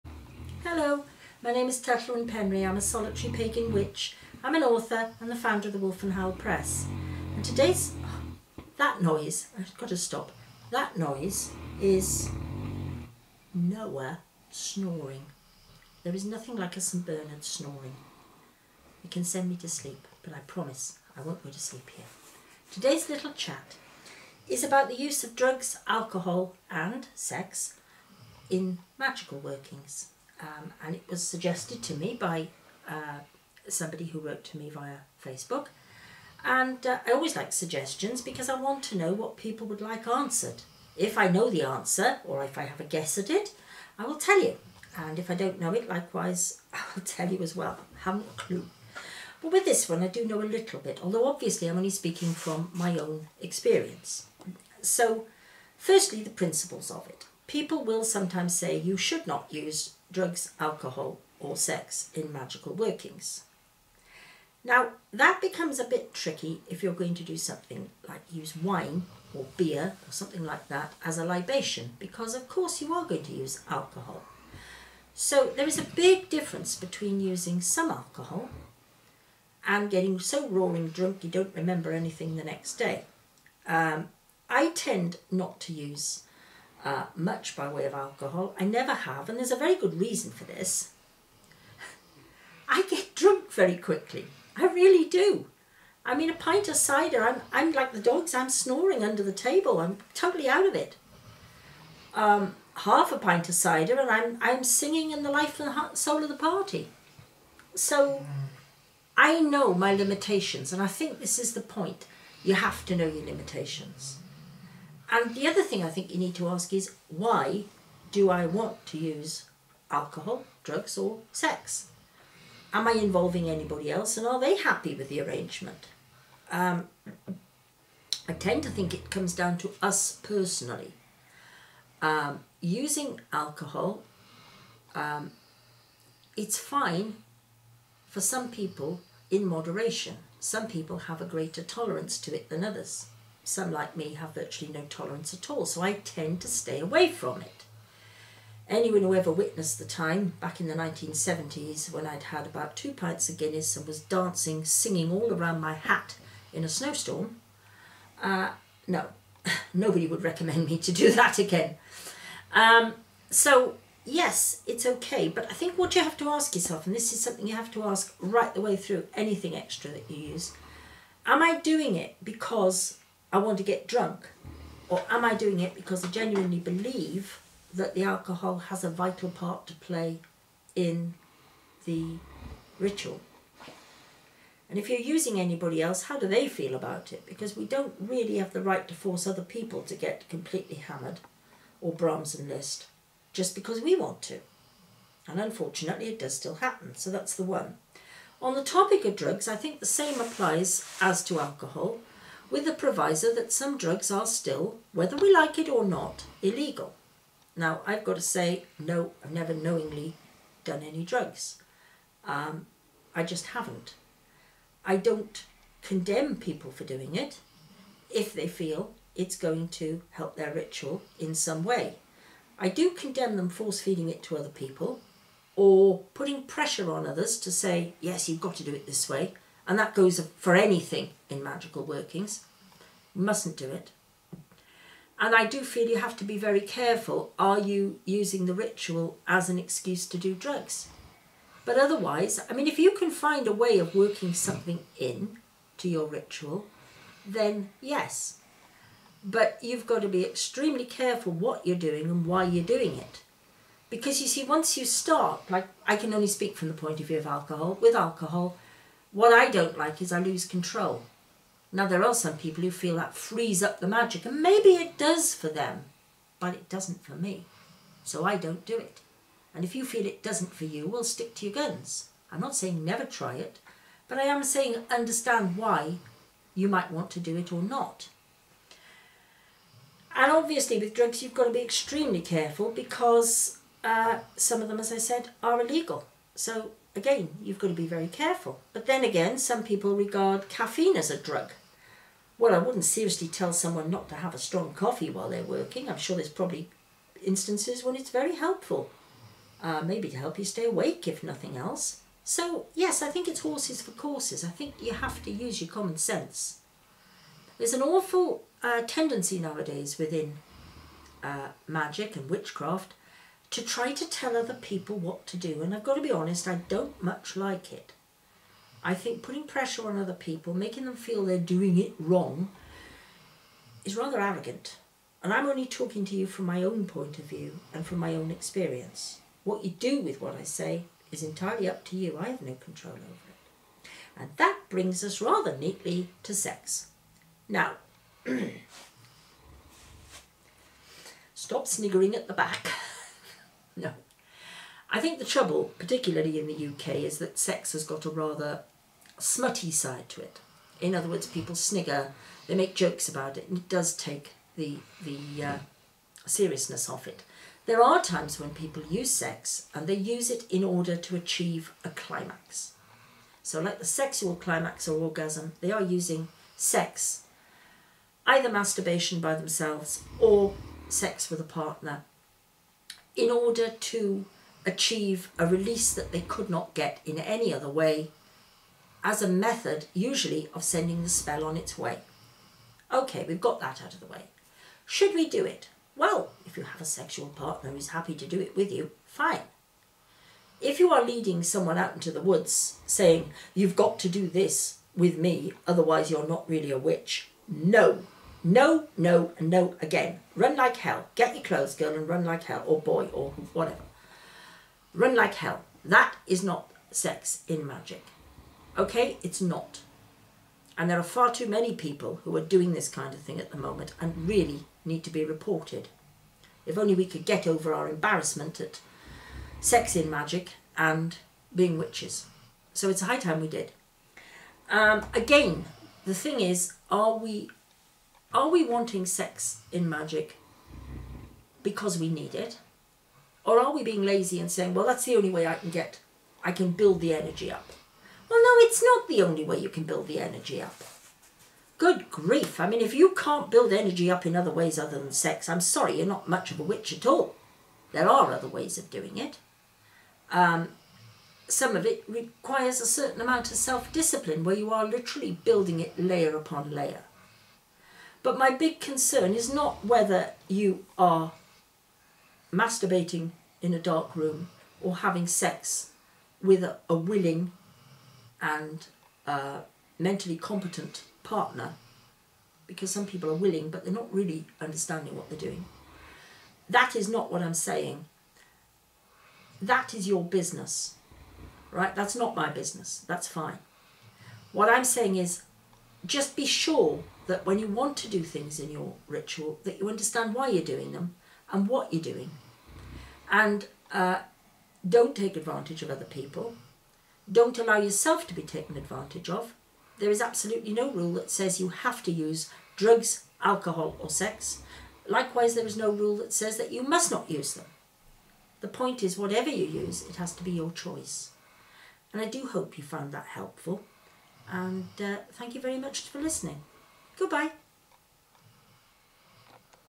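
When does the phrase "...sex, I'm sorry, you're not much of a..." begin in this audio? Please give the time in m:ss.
7:25.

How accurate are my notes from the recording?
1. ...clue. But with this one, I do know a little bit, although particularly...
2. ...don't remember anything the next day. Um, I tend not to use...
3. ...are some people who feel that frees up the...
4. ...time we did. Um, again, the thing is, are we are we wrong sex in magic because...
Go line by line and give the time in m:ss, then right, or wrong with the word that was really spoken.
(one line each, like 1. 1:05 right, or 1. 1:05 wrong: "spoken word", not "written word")
1. 0:48 wrong: "obviously", not "particularly"
2. 1:21 right
3. 4:22 right
4. 7:03 wrong: "wanting", not "wrong".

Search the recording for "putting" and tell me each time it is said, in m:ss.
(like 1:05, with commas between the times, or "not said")
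3:46, 5:19.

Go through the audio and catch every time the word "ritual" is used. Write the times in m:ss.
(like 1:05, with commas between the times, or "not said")
3:02, 3:40, 3:58, 4:06, 8:09.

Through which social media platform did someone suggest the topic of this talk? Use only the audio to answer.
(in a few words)
Facebook.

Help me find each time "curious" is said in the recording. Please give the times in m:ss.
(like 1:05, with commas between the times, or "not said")
not said.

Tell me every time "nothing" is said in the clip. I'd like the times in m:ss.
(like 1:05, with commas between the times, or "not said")
0:16, 5:01.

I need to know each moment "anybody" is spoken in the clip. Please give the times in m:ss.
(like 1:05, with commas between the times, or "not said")
2:03, 3:05.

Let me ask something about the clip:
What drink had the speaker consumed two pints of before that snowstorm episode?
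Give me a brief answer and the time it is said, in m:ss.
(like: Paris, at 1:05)
Guinness, at 2:33.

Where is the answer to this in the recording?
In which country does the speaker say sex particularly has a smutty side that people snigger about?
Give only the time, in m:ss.
5:46.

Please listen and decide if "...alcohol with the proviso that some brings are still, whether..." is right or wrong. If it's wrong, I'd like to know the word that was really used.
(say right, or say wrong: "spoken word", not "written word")
wrong: "drugs", not "brings".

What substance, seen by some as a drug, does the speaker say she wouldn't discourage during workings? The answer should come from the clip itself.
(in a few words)
Caffeine.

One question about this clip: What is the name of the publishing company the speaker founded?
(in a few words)
Wolfenhowle Press.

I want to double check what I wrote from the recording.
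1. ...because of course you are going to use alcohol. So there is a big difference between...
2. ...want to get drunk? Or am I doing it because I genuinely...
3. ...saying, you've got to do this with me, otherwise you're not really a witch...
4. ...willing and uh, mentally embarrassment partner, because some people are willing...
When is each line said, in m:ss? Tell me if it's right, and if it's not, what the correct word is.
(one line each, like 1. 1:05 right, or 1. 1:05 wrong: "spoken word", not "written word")
1. 1:11 right
2. 2:53 right
3. 6:32 right
4. 7:46 wrong: "competent", not "embarrassment".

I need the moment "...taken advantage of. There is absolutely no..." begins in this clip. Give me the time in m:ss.
8:18.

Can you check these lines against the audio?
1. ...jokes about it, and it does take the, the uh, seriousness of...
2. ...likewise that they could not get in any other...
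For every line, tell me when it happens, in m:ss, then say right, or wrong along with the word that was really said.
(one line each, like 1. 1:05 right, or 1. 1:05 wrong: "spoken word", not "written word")
1. 5:52 right
2. 6:15 wrong: "release", not "likewise".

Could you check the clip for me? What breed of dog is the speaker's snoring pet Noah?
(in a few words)
St Bernard.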